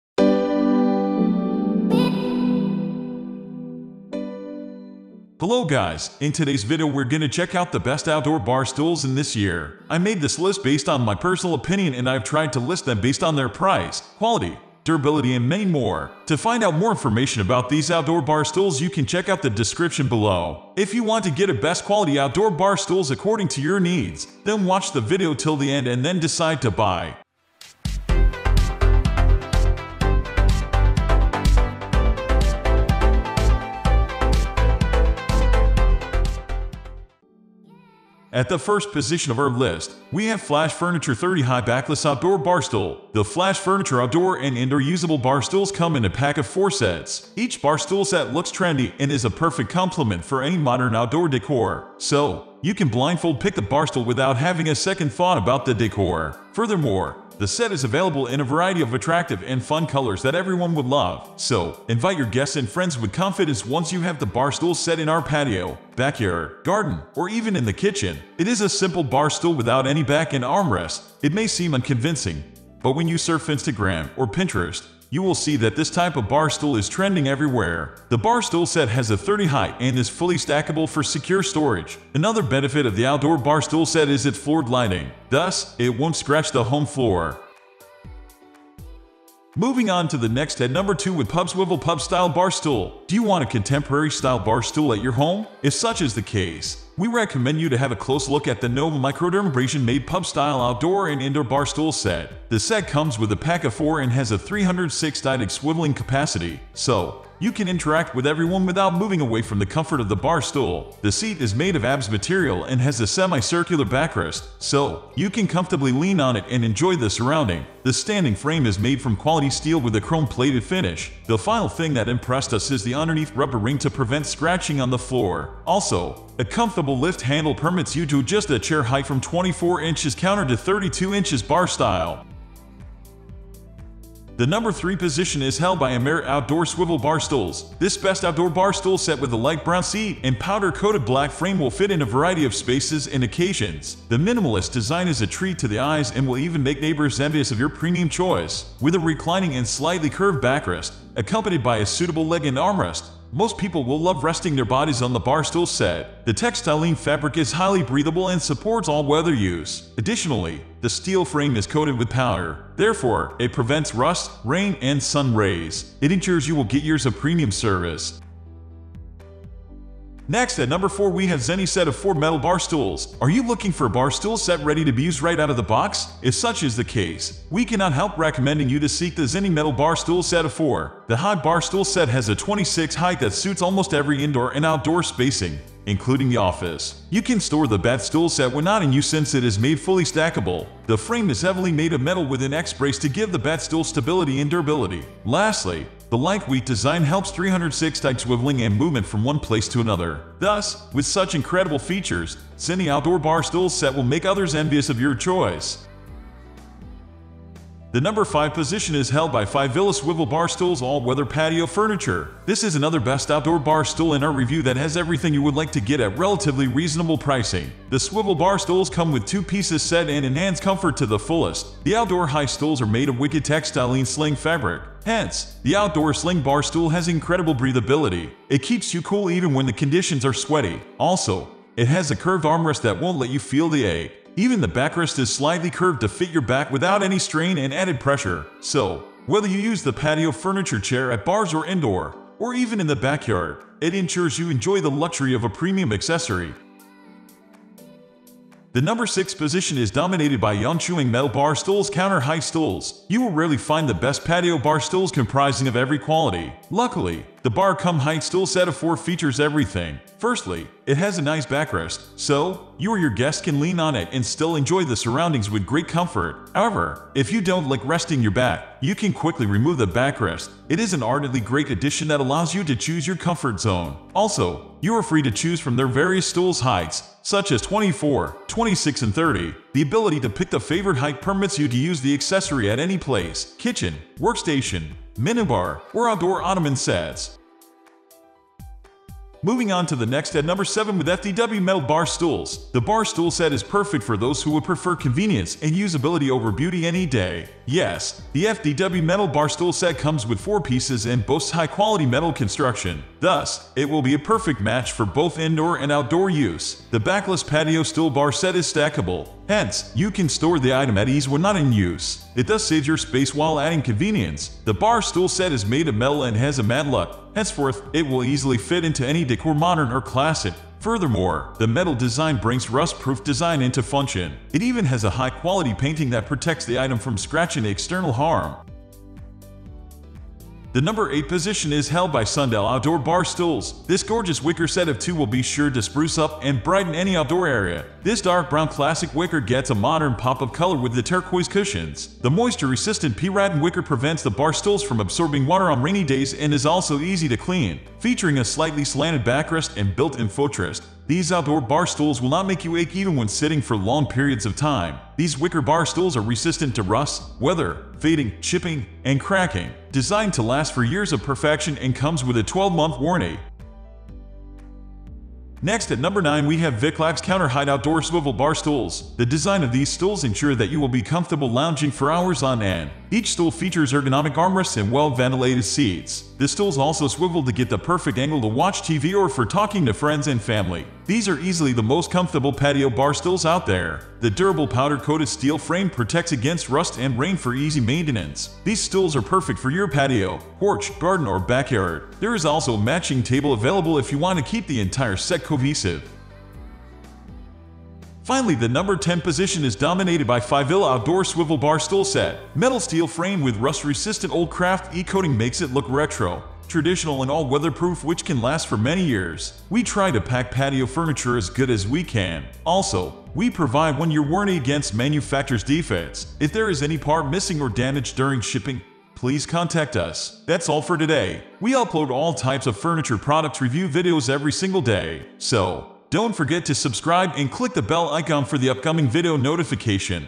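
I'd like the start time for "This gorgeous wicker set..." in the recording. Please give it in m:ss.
5:33.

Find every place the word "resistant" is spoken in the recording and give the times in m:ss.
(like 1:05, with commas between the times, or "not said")
5:42, 5:56, 6:43.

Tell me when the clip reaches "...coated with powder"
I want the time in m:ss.
2:41.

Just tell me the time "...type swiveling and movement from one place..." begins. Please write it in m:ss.
3:18.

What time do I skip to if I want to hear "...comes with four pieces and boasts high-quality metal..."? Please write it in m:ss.
4:59.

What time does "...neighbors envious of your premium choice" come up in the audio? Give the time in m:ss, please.
2:26.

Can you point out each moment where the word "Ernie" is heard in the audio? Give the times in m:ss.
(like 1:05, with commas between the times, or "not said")
not said.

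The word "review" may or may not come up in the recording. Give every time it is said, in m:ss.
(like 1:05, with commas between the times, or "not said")
3:34, 7:03.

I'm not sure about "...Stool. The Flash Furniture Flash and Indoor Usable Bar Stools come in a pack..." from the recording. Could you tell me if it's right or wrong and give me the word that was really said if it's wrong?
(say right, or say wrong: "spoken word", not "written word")
wrong: "Outdoor", not "Flash".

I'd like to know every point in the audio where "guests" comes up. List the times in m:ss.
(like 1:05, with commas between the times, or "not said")
1:02, 4:23.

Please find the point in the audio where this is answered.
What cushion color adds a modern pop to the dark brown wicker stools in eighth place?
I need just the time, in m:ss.
5:41.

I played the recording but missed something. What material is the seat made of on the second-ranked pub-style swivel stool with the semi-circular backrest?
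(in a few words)
ABS.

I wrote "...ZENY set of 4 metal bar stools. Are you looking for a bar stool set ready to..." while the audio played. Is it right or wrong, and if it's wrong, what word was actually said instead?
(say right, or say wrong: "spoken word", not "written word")
right.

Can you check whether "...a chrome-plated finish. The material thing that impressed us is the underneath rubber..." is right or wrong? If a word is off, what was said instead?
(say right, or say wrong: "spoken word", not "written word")
wrong: "final", not "material".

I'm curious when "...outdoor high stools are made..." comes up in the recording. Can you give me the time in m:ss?
3:41.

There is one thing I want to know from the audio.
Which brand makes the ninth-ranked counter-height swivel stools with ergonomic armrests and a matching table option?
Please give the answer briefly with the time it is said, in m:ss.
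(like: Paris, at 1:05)
VICCLAX, at 6:06.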